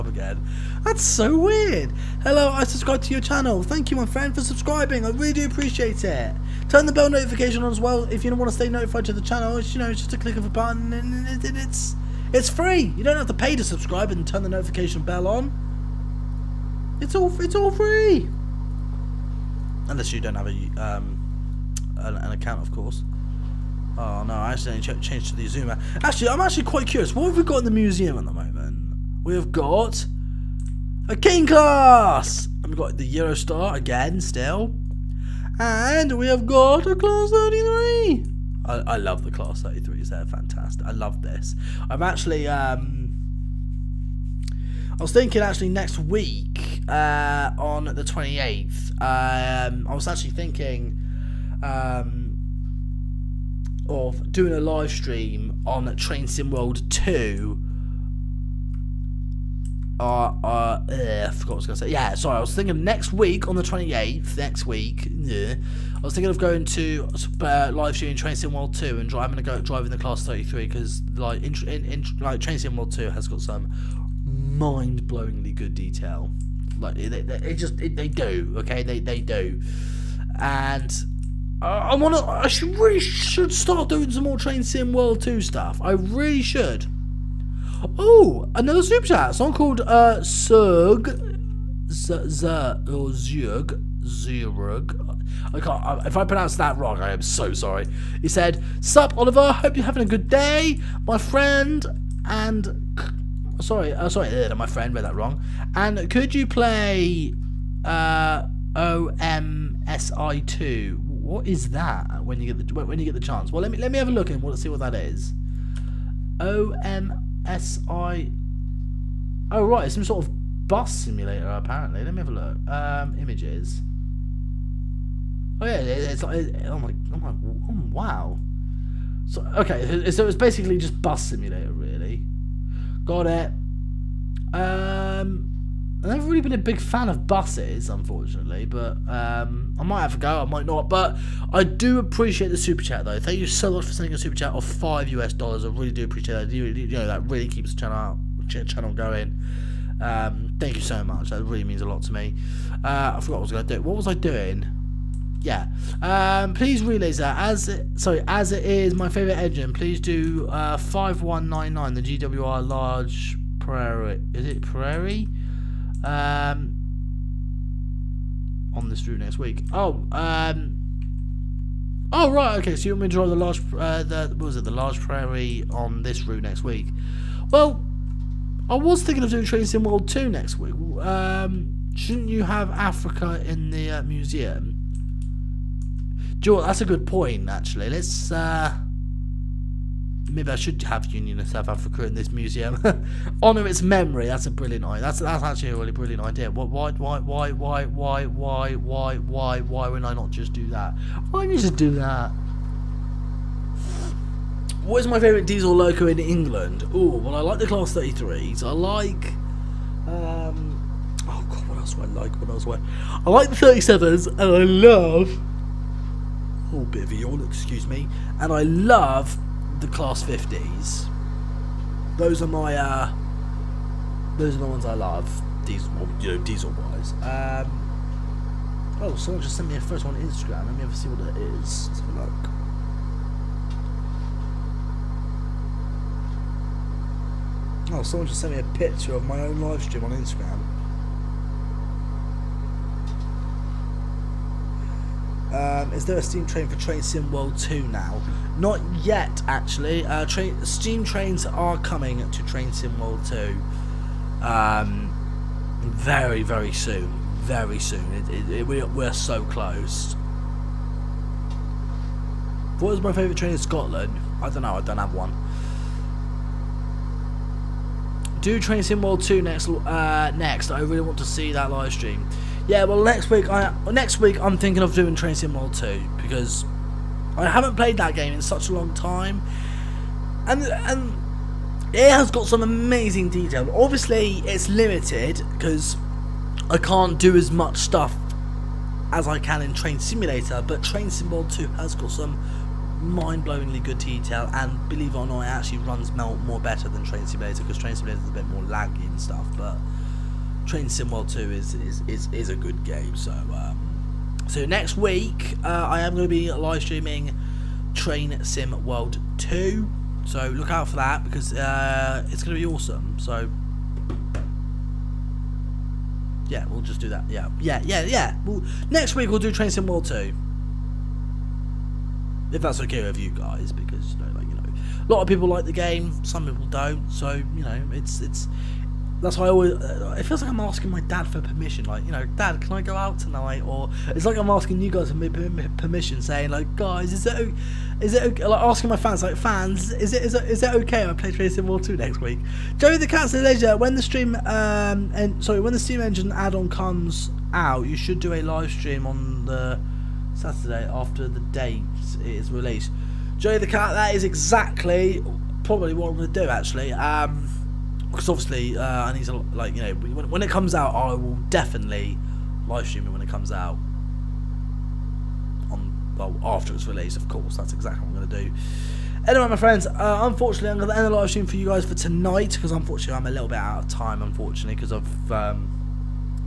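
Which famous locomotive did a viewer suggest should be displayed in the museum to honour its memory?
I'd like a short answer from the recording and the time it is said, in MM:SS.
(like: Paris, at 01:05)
Union of South Africa, at 03:11.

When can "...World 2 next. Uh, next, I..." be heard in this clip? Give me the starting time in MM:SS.
04:29.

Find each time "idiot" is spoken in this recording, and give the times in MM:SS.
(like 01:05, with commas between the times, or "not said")
not said.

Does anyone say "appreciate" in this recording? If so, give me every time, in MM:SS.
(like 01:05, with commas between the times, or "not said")
00:05, 02:21, 02:26.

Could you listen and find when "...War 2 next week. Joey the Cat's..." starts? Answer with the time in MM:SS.
05:41.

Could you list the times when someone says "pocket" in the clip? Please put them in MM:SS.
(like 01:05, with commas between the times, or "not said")
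not said.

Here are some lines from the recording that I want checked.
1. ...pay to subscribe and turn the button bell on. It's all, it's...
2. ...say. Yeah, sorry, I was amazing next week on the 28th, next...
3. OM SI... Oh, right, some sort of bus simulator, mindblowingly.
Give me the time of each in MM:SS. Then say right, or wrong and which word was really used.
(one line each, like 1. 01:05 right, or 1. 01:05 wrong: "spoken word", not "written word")
1. 00:13 wrong: "notification", not "button"
2. 01:01 wrong: "thinking", not "amazing"
3. 01:56 wrong: "apparently", not "mindblowingly".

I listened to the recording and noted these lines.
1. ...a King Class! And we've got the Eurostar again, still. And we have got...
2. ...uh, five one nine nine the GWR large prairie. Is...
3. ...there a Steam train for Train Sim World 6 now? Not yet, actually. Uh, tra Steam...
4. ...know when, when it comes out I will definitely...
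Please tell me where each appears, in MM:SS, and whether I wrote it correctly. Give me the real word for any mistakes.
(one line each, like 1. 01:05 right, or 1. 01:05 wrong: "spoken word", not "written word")
1. 00:31 right
2. 02:40 right
3. 04:06 wrong: "2", not "6"
4. 05:59 right.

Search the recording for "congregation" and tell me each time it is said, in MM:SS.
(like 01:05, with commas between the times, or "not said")
not said.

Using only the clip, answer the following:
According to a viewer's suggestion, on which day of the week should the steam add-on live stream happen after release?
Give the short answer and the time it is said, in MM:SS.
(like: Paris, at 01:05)
Saturday, at 05:50.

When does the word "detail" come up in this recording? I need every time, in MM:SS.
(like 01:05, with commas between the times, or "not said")
01:15, 04:43, 04:53.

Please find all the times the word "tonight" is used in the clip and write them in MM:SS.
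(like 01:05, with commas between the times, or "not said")
05:33, 06:11.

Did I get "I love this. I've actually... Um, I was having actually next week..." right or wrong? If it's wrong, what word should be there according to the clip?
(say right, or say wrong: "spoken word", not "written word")
wrong: "thinking", not "having".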